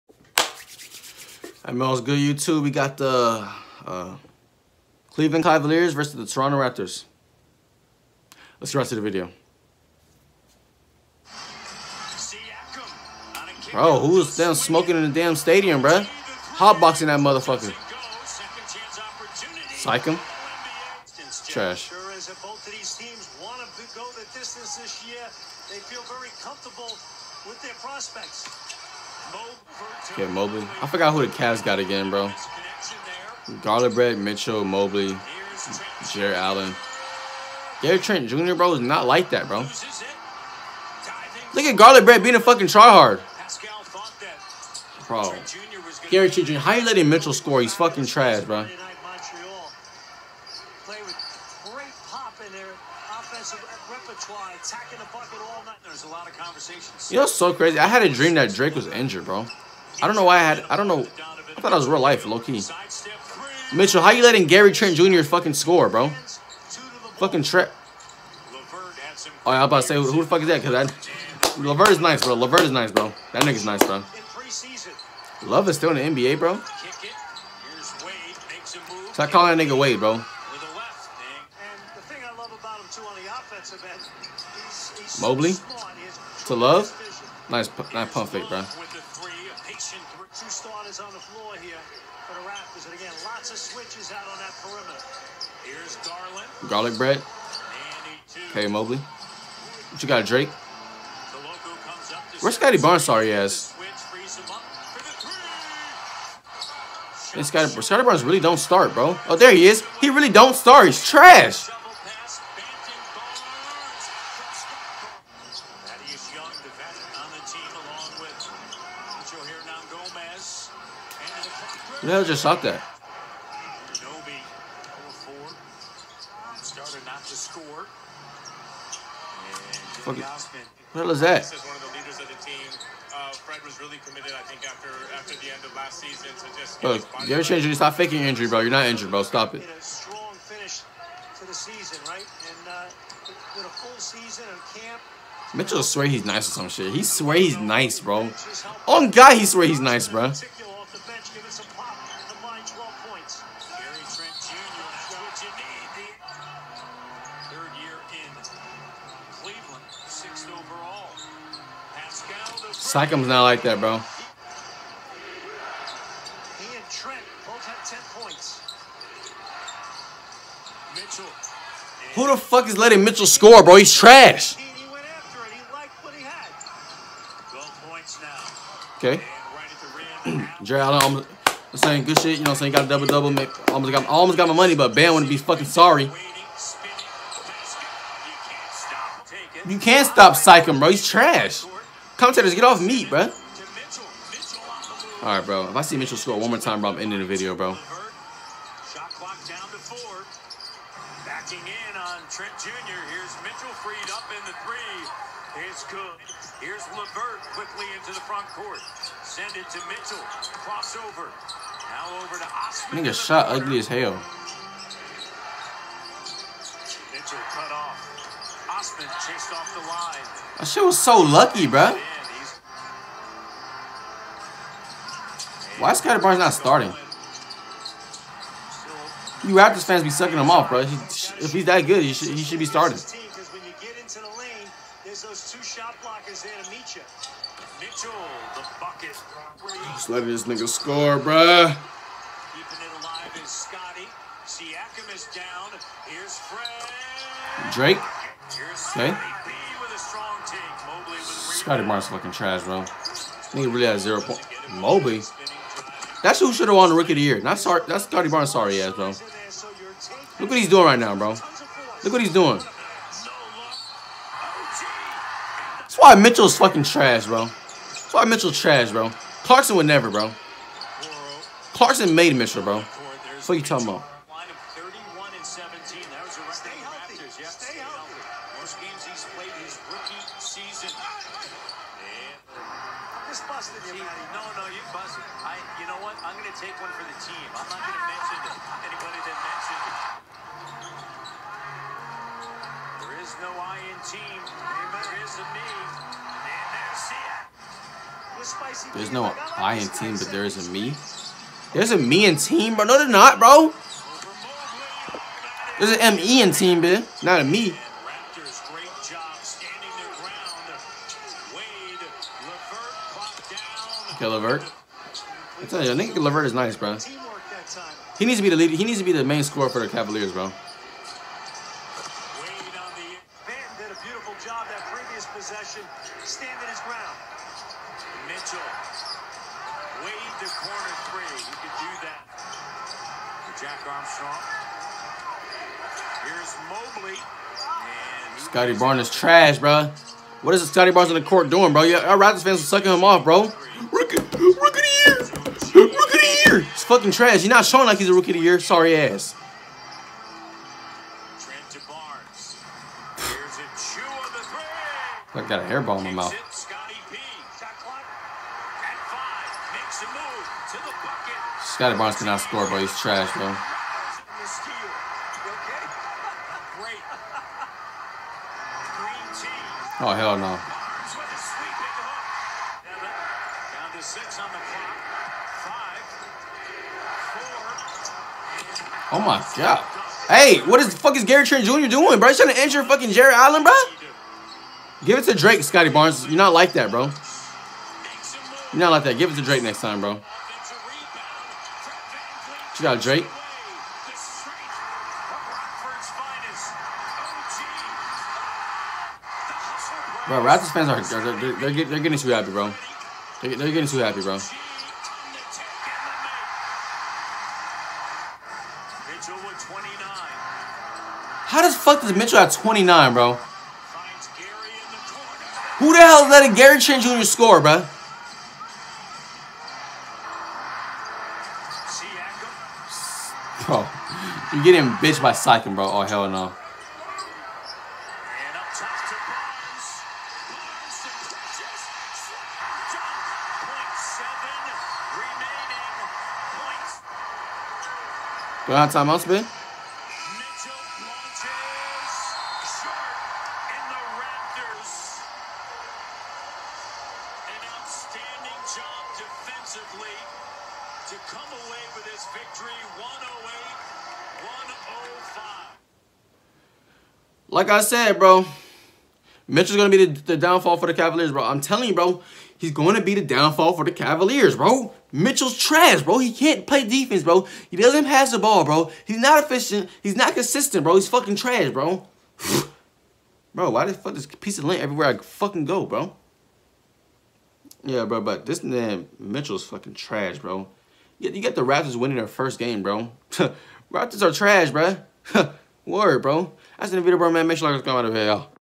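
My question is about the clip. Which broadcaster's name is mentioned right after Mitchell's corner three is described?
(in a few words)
Jack Armstrong.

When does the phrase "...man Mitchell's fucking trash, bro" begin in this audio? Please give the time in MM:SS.
07:58.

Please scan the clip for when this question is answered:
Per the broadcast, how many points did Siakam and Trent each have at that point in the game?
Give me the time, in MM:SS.
02:47.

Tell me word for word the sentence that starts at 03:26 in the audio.
Here's Levert quickly into the front court.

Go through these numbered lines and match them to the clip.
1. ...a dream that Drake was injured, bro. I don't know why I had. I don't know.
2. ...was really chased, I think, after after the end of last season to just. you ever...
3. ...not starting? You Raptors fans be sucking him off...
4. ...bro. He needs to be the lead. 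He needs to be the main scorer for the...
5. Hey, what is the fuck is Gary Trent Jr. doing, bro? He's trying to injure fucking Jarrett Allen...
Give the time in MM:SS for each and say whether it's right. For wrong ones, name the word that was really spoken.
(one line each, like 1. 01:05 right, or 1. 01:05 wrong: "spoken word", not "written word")
1. 00:58 right
2. 02:13 wrong: "committed", not "chased"
3. 03:46 right
4. 05:16 right
5. 06:20 right.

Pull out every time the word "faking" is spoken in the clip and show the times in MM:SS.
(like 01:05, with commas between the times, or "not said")
02:17.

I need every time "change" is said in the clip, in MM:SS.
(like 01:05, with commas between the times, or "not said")
02:17.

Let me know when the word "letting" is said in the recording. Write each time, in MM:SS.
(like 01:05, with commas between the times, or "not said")
00:46, 01:04, 02:52, 04:00, 06:56.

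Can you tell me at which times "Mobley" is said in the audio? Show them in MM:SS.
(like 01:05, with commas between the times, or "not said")
00:30, 00:34, 01:25, 01:38, 04:14, 05:36.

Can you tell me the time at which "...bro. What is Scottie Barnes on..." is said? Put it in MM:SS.
05:39.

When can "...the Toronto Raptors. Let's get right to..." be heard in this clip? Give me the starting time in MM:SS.
00:06.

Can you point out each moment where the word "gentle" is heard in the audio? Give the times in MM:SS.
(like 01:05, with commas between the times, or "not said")
not said.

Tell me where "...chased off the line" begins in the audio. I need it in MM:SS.
03:39.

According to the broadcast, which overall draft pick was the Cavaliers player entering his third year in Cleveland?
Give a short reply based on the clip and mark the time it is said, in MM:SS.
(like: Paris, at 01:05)
sixth overall, at 02:40.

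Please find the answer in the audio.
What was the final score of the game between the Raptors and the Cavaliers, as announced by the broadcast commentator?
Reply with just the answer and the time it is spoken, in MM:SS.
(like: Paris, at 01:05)
108-105, at 07:32.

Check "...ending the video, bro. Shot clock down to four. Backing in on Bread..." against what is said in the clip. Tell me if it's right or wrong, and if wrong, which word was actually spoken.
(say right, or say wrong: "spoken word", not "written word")
wrong: "Trent", not "Bread".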